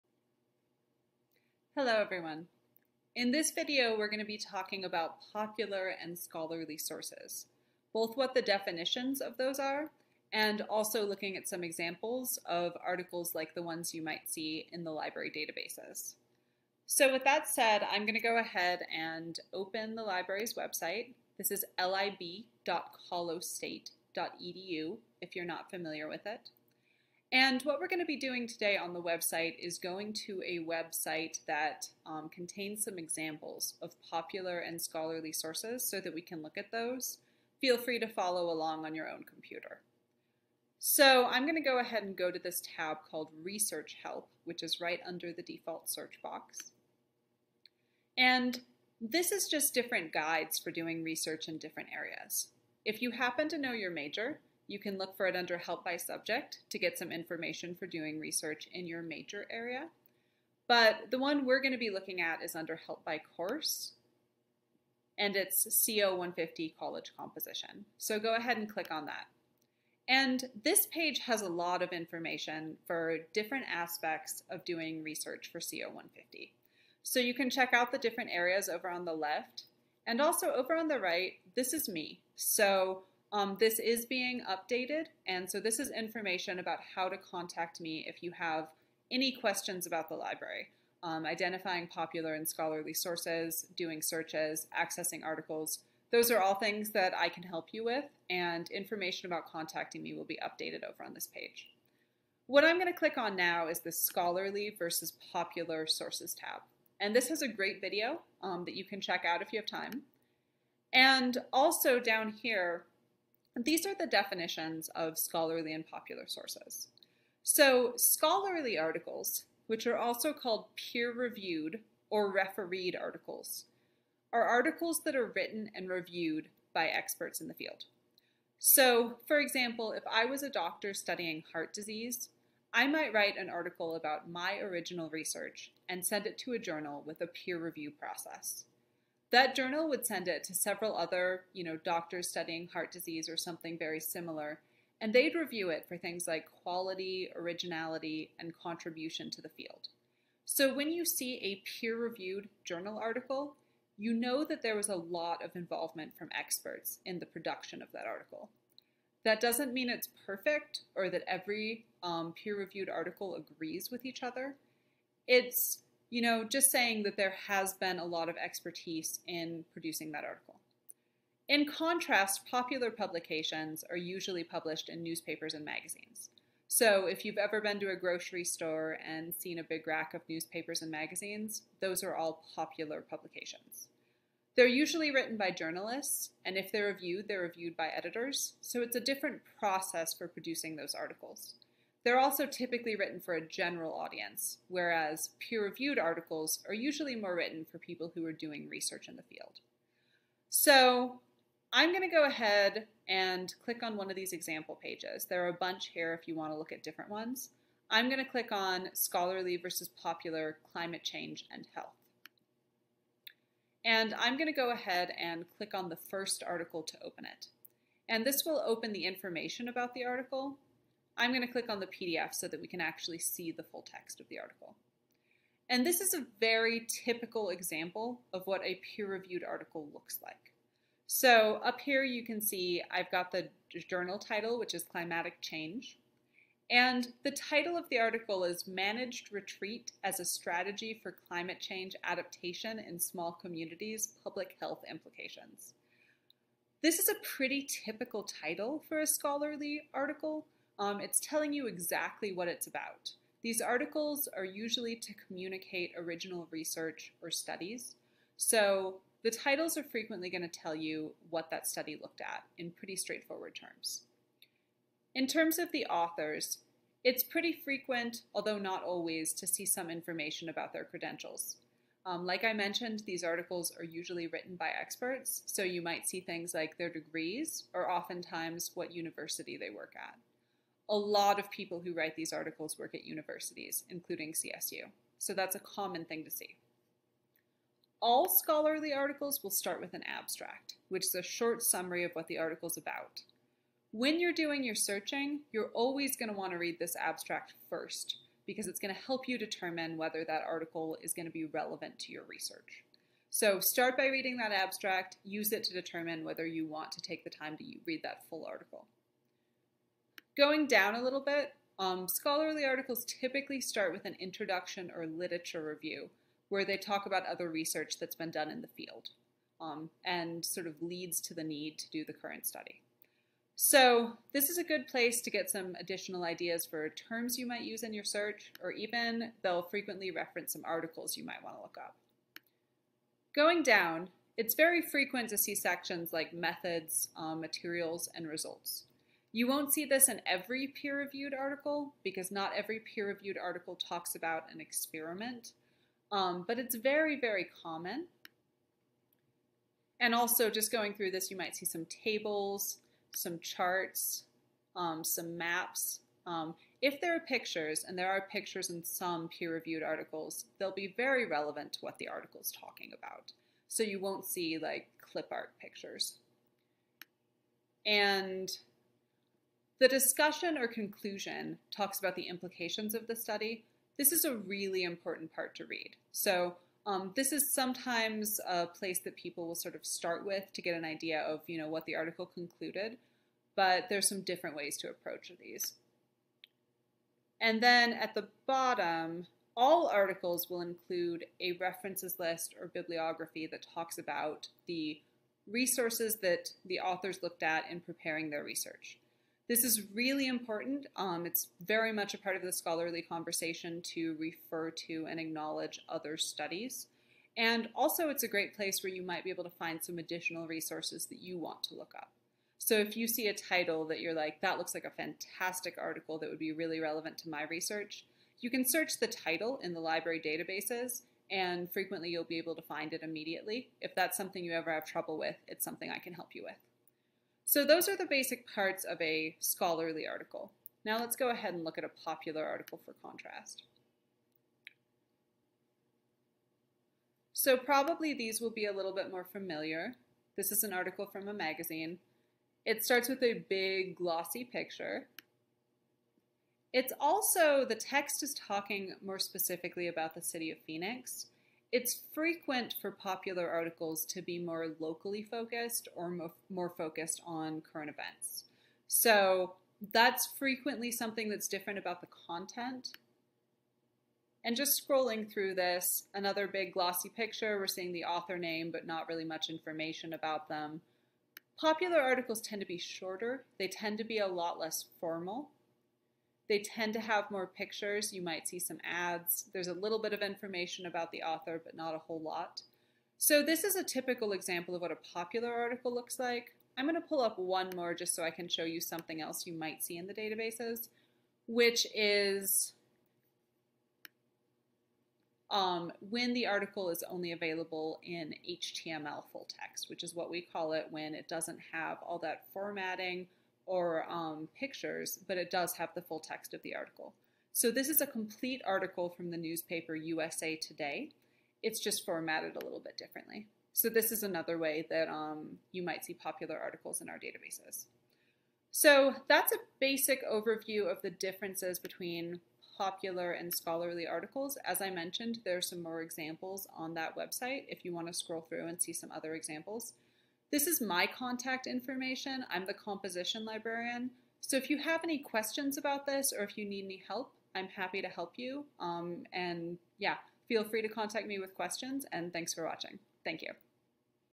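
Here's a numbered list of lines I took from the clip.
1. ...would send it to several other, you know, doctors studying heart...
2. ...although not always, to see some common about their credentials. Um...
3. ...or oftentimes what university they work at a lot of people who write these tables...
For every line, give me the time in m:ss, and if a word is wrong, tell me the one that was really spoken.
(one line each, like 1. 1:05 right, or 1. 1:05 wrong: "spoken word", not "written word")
1. 2:19 right
2. 4:28 wrong: "information", not "common"
3. 4:37 wrong: "articles", not "tables".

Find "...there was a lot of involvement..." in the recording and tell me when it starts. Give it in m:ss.
2:34.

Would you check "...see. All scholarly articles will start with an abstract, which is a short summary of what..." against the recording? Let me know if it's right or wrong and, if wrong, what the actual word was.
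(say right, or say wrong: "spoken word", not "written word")
right.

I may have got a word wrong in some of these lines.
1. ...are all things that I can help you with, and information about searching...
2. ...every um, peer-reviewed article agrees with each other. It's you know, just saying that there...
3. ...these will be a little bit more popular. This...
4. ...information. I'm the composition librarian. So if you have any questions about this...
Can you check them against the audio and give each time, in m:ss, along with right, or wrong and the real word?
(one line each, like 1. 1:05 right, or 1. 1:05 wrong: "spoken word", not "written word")
1. 1:36 wrong: "contacting", not "searching"
2. 2:41 right
3. 7:18 wrong: "familiar", not "popular"
4. 8:51 right.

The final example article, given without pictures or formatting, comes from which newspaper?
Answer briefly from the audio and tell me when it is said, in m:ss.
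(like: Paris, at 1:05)
USA Today, at 8:29.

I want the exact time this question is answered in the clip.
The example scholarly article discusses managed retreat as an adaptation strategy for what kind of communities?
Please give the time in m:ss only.
4:02.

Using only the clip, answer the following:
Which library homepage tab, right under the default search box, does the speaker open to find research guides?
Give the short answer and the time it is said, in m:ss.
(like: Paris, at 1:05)
Research Help, at 0:43.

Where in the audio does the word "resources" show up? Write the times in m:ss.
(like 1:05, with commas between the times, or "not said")
6:35, 6:50.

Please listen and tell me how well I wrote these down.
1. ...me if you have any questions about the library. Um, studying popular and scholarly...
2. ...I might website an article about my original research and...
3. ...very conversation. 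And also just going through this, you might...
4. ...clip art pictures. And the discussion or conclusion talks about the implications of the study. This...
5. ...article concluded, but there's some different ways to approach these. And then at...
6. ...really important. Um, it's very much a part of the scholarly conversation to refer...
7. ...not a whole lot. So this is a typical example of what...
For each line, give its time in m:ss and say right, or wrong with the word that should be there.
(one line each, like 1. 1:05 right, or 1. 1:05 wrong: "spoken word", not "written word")
1. 1:27 wrong: "identifying", not "studying"
2. 2:12 wrong: "write", not "website"
3. 5:47 wrong: "common", not "conversation"
4. 6:05 right
5. 6:21 right
6. 6:39 right
7. 8:01 right.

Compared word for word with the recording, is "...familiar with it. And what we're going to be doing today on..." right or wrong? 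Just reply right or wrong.
right.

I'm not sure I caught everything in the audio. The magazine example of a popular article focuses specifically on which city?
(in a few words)
Phoenix.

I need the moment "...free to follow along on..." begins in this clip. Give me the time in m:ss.
0:37.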